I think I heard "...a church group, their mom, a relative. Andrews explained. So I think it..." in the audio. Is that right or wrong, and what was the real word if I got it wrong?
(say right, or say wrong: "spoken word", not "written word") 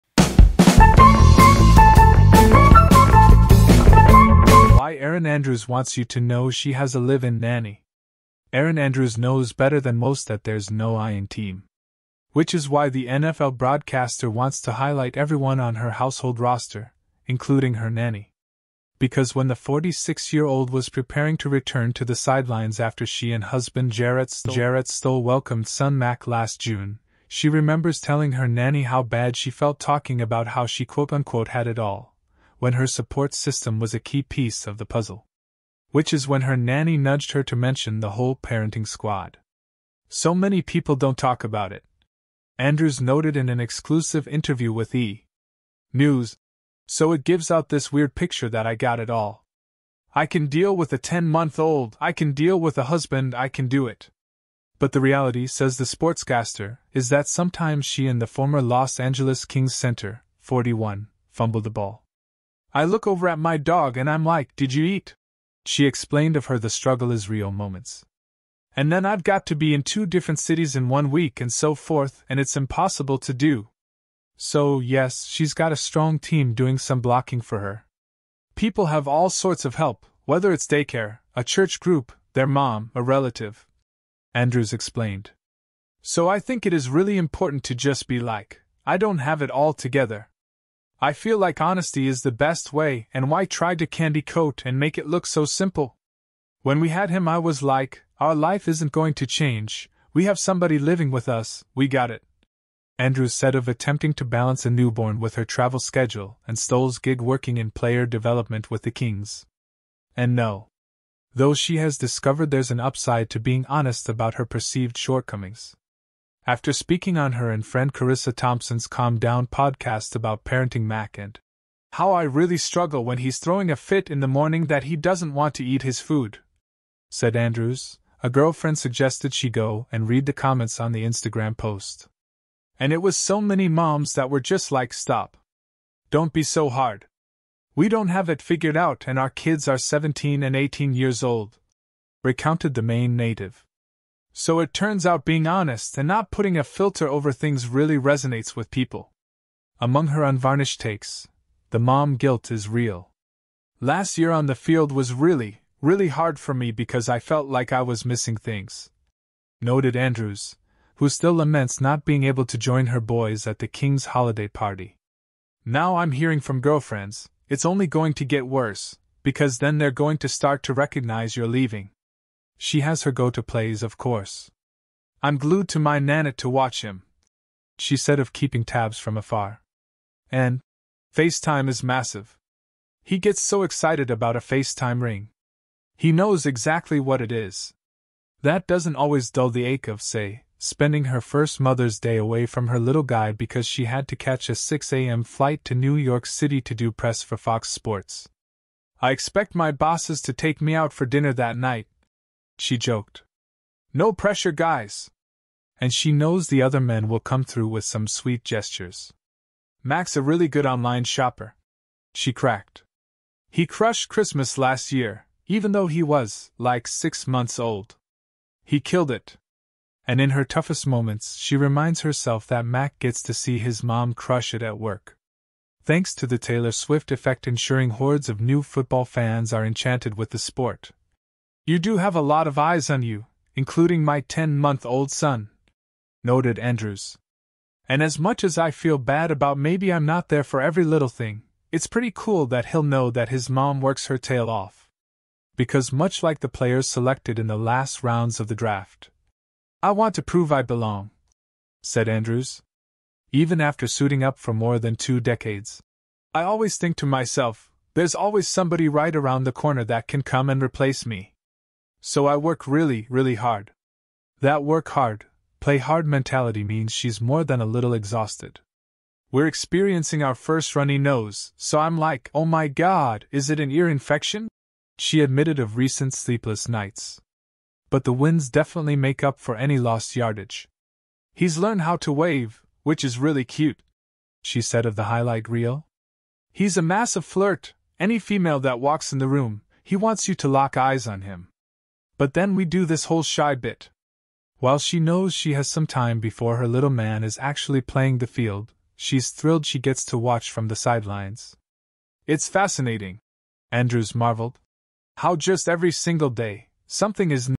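right.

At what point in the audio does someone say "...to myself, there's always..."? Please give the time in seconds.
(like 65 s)
256 s.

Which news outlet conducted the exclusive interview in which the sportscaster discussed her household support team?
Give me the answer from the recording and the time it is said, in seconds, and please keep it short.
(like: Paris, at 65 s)
E! News, at 44 s.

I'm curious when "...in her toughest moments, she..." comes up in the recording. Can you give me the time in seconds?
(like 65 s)
220 s.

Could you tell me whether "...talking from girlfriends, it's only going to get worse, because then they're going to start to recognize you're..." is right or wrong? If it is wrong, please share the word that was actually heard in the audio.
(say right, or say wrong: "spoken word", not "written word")
wrong: "hearing", not "talking".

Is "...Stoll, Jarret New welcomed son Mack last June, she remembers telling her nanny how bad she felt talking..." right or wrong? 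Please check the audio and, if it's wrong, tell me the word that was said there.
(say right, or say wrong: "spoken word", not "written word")
wrong: "Stoll", not "New".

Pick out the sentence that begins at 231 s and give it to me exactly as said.
You do have a lot of eyes on you, including my 10 month old son, noted Andrews.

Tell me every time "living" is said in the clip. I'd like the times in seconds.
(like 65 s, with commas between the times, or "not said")
100 s.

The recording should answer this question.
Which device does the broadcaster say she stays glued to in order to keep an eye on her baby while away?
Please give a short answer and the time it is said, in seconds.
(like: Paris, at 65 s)
Nanit, at 175 s.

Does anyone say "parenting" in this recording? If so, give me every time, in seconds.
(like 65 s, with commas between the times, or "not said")
38 s, 120 s.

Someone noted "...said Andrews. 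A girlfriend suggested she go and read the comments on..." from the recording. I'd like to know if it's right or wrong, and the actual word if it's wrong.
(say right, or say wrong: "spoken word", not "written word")
right.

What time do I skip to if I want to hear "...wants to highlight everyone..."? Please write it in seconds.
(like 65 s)
14 s.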